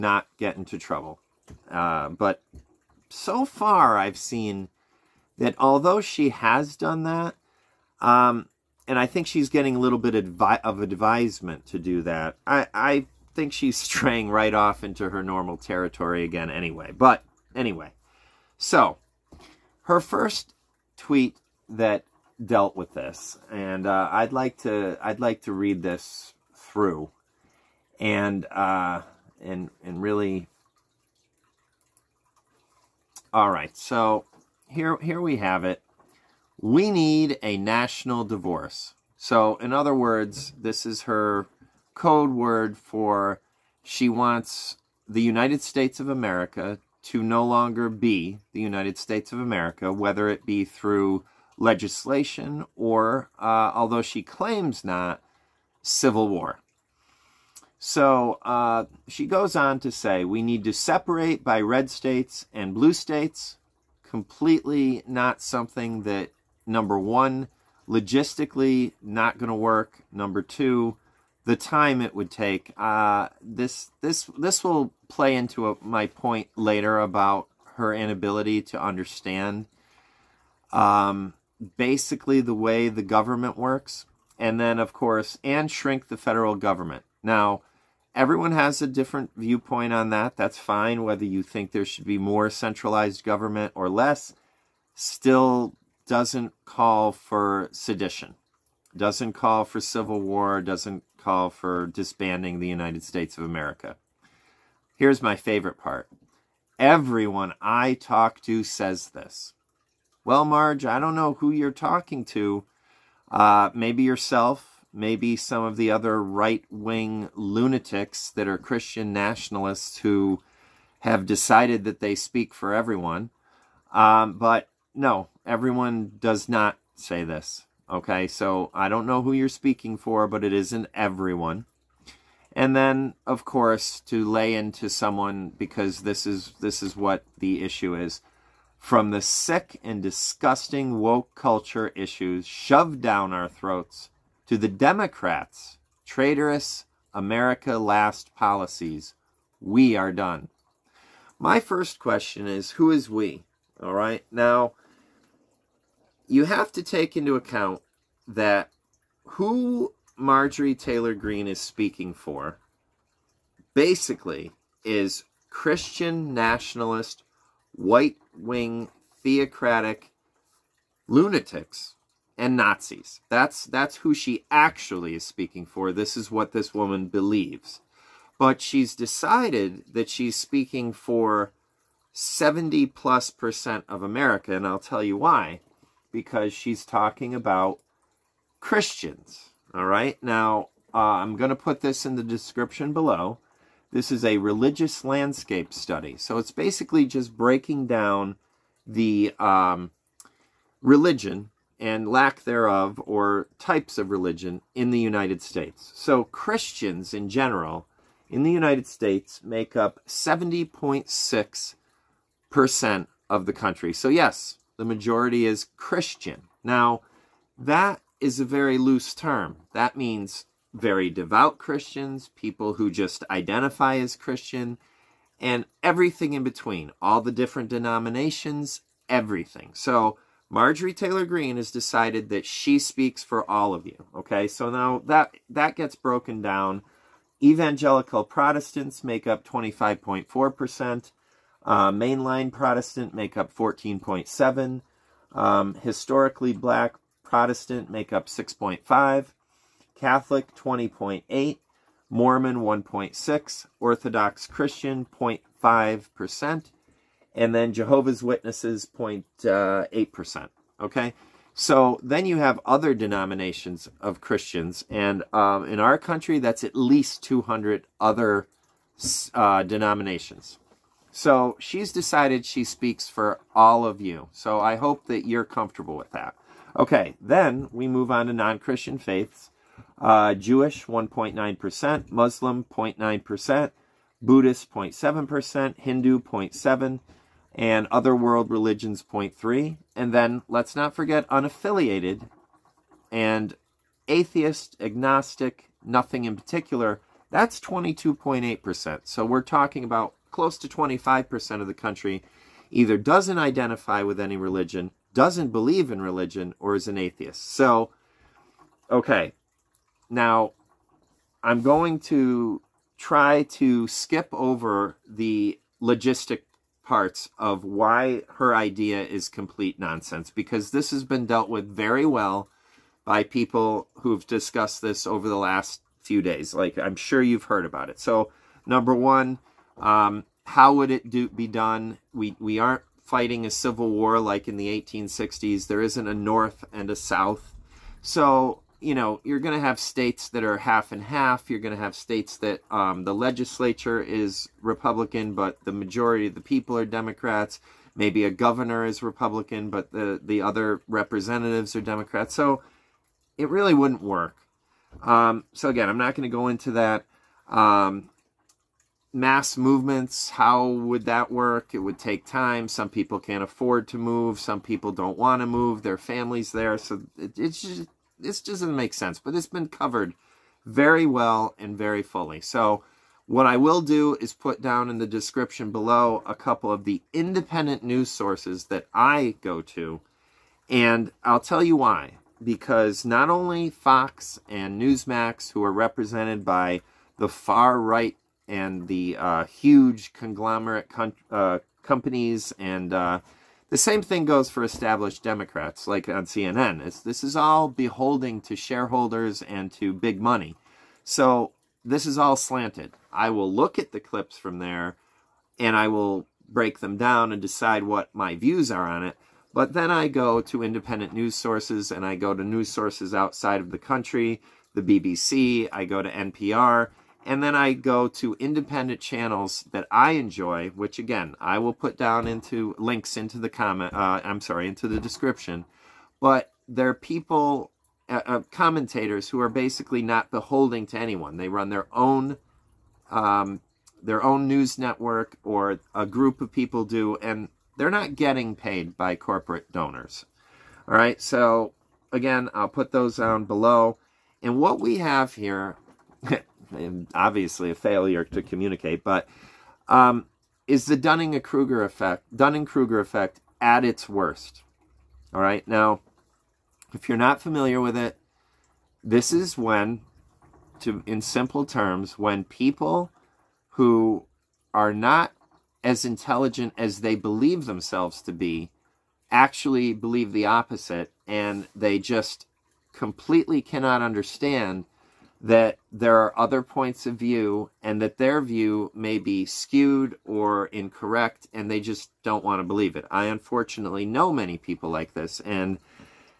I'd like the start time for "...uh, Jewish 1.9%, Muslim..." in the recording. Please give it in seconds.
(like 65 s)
279 s.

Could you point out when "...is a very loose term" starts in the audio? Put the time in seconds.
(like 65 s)
218 s.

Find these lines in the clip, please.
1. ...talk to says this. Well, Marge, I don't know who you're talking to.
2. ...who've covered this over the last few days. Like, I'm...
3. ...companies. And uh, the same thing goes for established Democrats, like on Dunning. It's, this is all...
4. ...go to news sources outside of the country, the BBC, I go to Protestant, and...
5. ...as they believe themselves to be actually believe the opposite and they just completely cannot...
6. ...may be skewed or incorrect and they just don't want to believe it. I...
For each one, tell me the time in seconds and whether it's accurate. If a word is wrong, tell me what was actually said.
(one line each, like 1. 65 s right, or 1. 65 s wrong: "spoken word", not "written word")
1. 107 s right
2. 323 s wrong: "discussed", not "covered"
3. 391 s wrong: "CNN", not "Dunning"
4. 412 s wrong: "NPR", not "Protestant"
5. 466 s right
6. 478 s right.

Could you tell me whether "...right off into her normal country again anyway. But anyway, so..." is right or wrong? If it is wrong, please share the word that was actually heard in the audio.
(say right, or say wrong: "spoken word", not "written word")
wrong: "territory", not "country".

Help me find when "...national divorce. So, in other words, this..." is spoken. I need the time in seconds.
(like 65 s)
37 s.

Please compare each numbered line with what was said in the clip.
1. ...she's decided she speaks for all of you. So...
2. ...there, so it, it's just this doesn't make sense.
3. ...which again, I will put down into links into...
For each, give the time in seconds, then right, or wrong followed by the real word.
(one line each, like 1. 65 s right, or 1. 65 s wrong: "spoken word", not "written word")
1. 271 s right
2. 366 s right
3. 420 s right.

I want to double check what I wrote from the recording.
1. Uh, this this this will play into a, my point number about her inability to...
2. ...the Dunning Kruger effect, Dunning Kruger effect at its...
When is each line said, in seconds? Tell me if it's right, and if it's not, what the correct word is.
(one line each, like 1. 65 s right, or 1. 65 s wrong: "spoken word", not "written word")
1. 72 s wrong: "later", not "number"
2. 450 s right.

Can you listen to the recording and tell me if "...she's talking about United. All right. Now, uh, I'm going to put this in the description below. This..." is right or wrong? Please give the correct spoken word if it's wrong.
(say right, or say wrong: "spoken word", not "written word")
wrong: "Christians", not "United".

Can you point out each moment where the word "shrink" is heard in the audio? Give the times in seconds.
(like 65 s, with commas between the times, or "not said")
85 s.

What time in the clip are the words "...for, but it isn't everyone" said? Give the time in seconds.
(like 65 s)
129 s.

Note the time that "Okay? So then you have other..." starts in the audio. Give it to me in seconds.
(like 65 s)
260 s.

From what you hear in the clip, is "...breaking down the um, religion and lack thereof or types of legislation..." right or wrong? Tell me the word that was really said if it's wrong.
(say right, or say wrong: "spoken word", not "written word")
wrong: "religion", not "legislation".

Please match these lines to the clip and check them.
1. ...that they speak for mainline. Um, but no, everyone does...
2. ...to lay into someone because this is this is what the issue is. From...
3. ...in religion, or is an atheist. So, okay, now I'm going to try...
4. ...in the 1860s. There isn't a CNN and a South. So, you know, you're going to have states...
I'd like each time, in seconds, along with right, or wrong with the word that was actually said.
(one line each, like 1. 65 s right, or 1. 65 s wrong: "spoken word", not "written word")
1. 121 s wrong: "everyone", not "mainline"
2. 134 s right
3. 305 s right
4. 334 s wrong: "North", not "CNN".